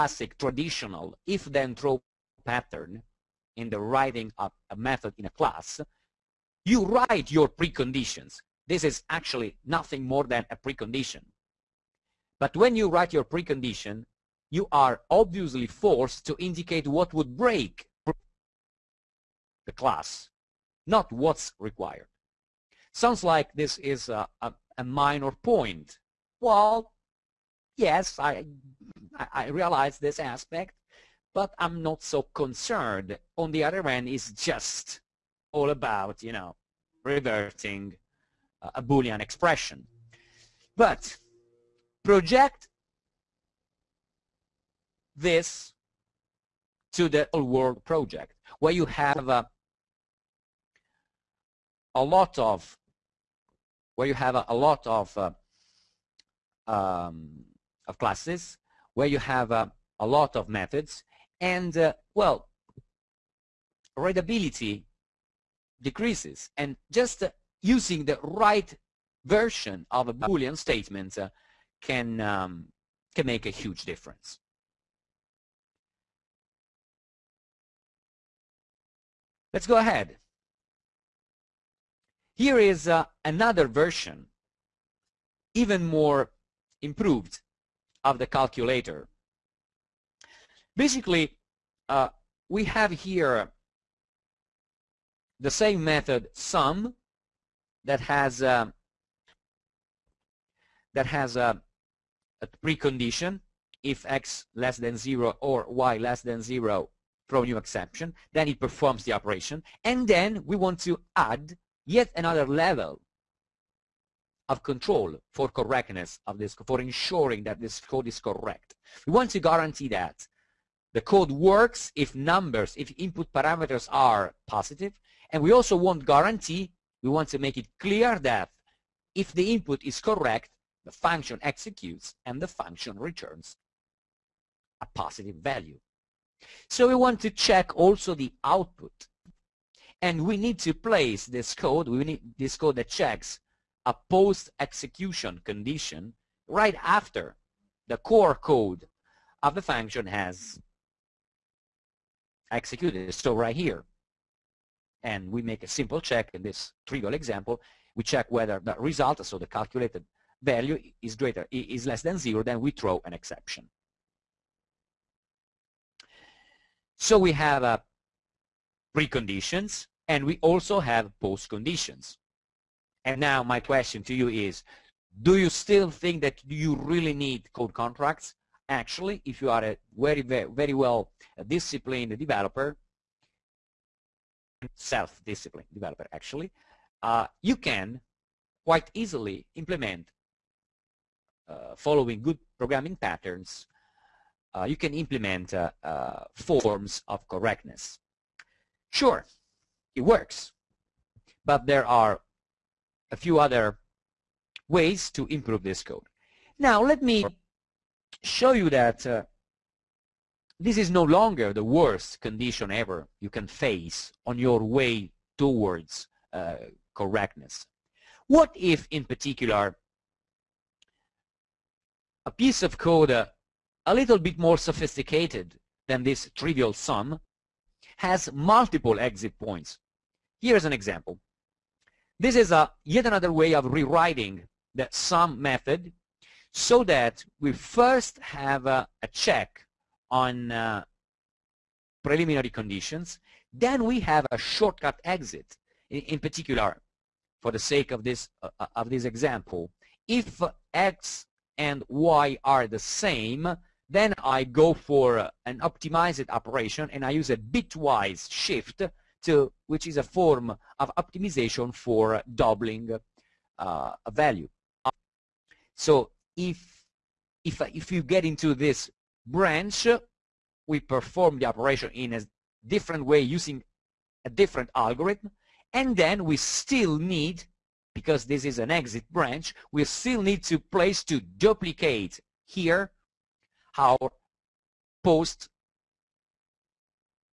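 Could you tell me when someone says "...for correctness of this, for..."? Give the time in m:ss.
1:55.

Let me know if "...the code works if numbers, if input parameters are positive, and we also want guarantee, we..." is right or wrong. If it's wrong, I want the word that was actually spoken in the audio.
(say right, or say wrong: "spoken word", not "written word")
right.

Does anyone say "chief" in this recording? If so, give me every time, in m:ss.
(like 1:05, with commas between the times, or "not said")
not said.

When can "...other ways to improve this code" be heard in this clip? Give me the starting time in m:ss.
3:23.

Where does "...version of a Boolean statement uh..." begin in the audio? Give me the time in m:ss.
1:09.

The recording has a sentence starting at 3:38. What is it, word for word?
What if, in particular, a piece of code uh, a little bit more sophisticated than this trivial sum, has multiple exit points.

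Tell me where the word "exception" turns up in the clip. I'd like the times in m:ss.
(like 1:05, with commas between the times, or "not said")
1:47, 2:43.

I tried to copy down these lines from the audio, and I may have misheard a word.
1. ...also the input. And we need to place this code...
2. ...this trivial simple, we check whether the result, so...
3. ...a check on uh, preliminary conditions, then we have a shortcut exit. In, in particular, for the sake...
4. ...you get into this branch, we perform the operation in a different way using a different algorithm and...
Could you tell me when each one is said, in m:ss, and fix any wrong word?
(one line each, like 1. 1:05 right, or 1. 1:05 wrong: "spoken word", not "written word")
1. 2:17 wrong: "output", not "input"
2. 2:36 wrong: "example", not "simple"
3. 3:59 right
4. 4:27 right.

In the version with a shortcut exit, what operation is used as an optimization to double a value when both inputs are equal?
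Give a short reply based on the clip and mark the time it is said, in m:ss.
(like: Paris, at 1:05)
bitwise shift, at 4:17.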